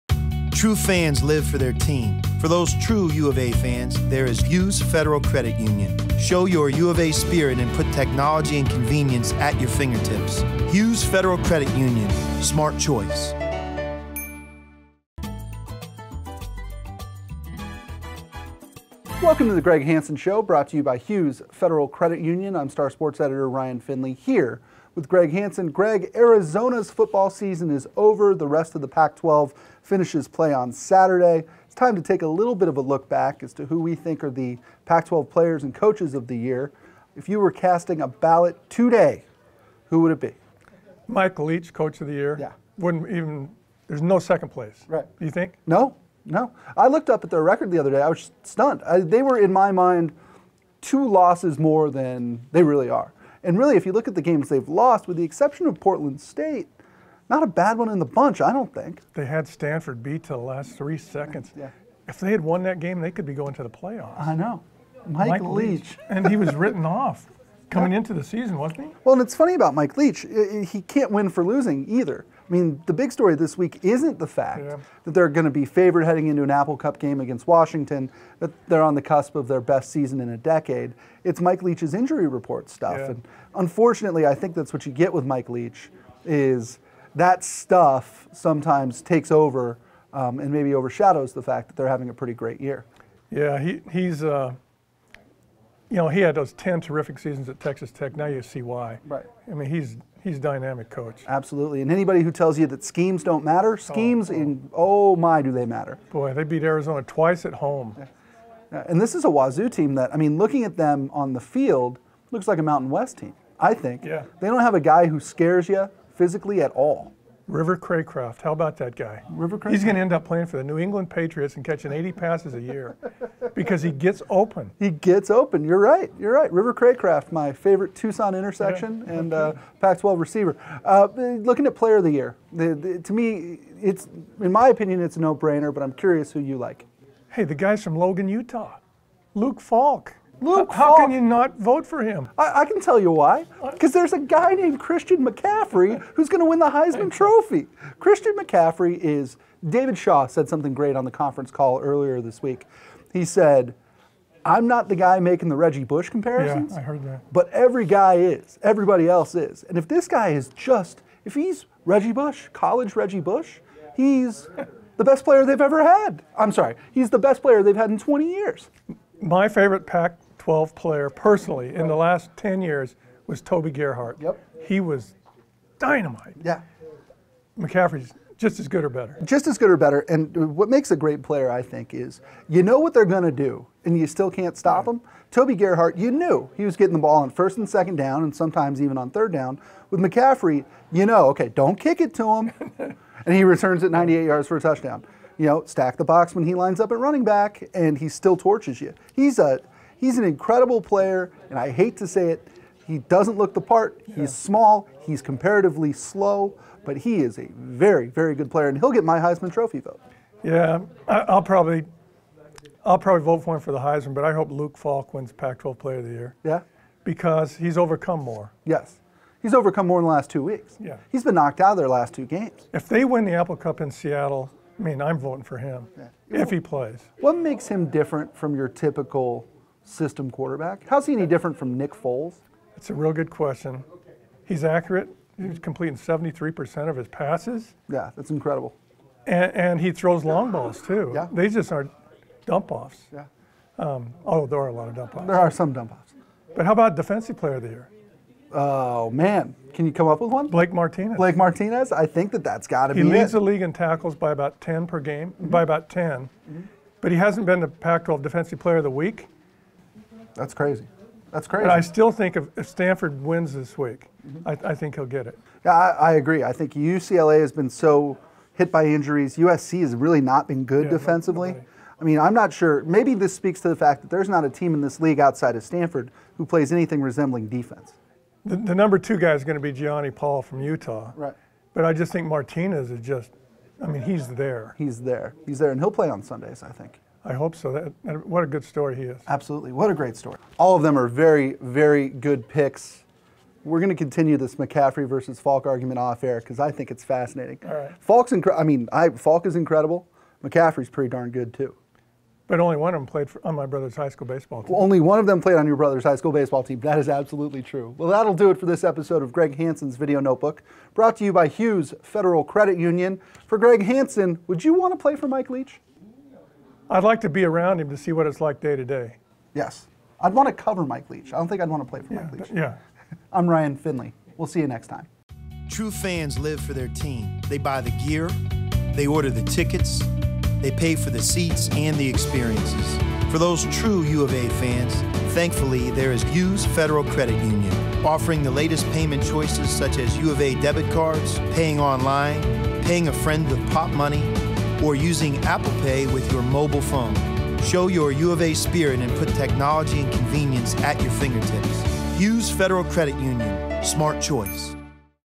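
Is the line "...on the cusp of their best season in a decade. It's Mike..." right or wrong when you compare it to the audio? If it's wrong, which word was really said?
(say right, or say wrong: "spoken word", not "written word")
right.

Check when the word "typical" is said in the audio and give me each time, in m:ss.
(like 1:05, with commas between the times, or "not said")
3:48.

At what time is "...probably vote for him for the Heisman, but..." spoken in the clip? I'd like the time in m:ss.
3:32.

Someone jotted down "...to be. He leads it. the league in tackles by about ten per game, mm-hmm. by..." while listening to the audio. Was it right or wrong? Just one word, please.
right.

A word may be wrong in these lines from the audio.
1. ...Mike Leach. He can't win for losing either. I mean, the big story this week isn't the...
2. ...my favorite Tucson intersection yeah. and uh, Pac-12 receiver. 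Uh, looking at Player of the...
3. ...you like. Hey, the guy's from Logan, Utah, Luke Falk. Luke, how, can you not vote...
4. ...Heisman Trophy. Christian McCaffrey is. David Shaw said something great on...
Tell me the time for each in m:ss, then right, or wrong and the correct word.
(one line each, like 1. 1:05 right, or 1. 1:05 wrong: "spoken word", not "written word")
1. 1:09 right
2. 2:07 right
3. 2:16 right
4. 2:26 right.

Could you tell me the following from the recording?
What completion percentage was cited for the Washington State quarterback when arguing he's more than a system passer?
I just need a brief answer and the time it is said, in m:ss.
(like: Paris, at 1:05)
73%, at 3:55.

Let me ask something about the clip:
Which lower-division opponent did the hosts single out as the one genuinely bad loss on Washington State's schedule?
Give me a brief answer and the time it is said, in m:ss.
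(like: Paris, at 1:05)
Portland State, at 0:55.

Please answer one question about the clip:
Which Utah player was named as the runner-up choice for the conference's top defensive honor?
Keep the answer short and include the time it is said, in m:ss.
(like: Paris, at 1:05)
Gionni Paul, at 4:39.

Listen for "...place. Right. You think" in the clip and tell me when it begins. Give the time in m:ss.
0:44.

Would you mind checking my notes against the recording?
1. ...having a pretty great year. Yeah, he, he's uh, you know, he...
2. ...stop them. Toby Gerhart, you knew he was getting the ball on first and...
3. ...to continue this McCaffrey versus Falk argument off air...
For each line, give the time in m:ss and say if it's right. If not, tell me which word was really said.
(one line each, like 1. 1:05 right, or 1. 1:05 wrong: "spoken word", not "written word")
1. 1:31 right
2. 3:04 right
3. 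4:53 right.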